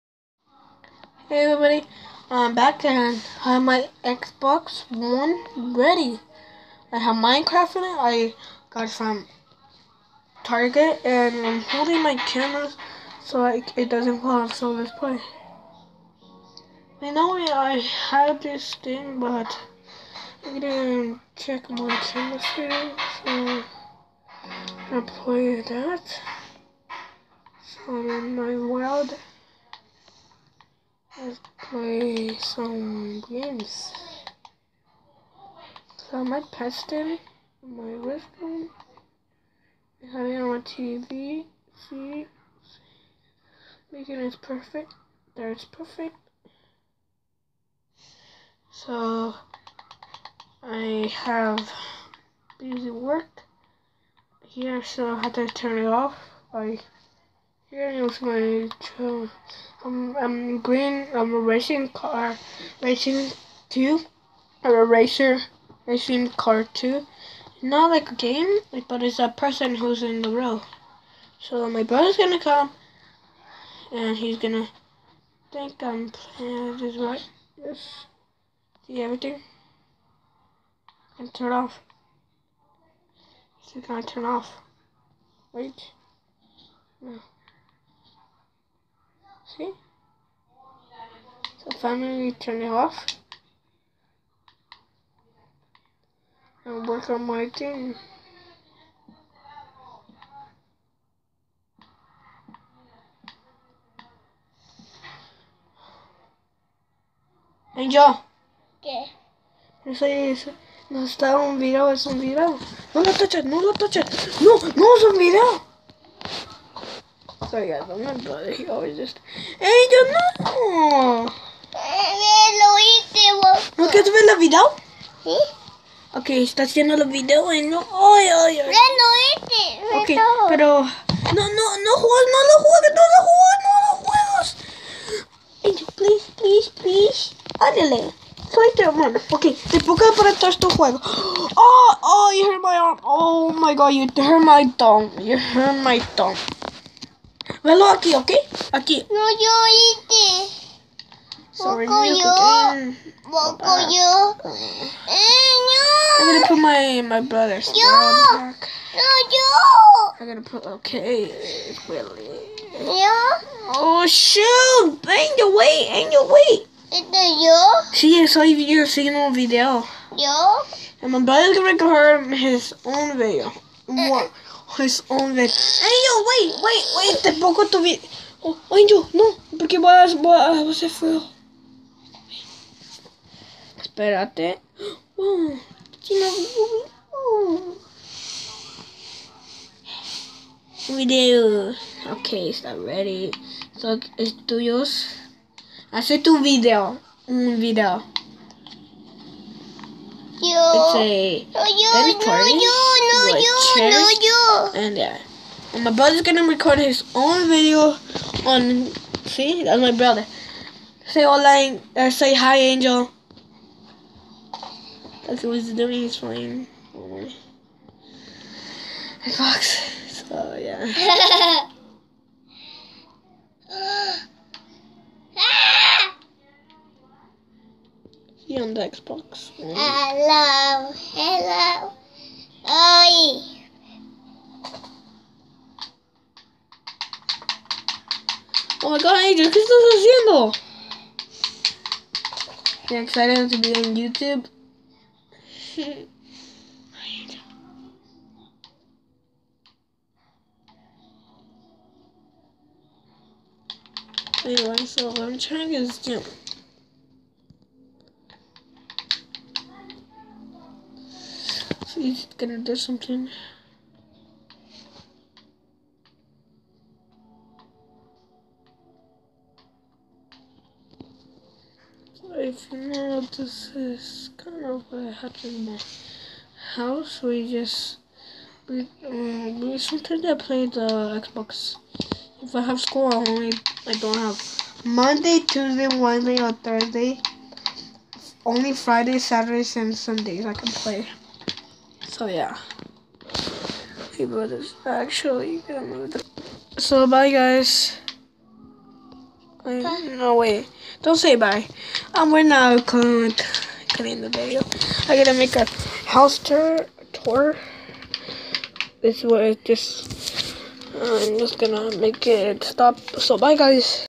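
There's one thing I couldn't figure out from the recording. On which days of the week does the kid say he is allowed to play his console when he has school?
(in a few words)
Fridays, Saturdays, and Sundays.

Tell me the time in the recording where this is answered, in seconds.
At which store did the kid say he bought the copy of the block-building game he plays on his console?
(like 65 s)
10 s.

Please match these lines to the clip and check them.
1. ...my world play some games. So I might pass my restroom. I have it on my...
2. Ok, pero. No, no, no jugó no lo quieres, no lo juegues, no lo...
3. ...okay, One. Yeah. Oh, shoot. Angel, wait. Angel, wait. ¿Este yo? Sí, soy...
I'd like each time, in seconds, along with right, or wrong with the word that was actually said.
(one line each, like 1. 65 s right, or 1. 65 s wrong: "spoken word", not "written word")
1. 28 s right
2. 130 s wrong: "juegues", not "quieres"
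3. 160 s wrong: "Really", not "One".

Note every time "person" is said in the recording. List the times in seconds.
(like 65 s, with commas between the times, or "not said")
69 s.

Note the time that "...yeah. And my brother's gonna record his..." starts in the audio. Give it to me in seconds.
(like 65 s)
204 s.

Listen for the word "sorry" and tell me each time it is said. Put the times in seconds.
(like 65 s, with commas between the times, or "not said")
117 s, 151 s.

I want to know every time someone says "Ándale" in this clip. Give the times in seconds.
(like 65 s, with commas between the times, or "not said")
137 s.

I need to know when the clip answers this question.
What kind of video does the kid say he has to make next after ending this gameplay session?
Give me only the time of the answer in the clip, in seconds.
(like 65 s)
306 s.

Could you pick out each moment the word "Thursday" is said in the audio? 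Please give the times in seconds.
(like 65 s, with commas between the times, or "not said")
286 s.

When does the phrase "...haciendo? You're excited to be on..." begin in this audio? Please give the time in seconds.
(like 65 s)
239 s.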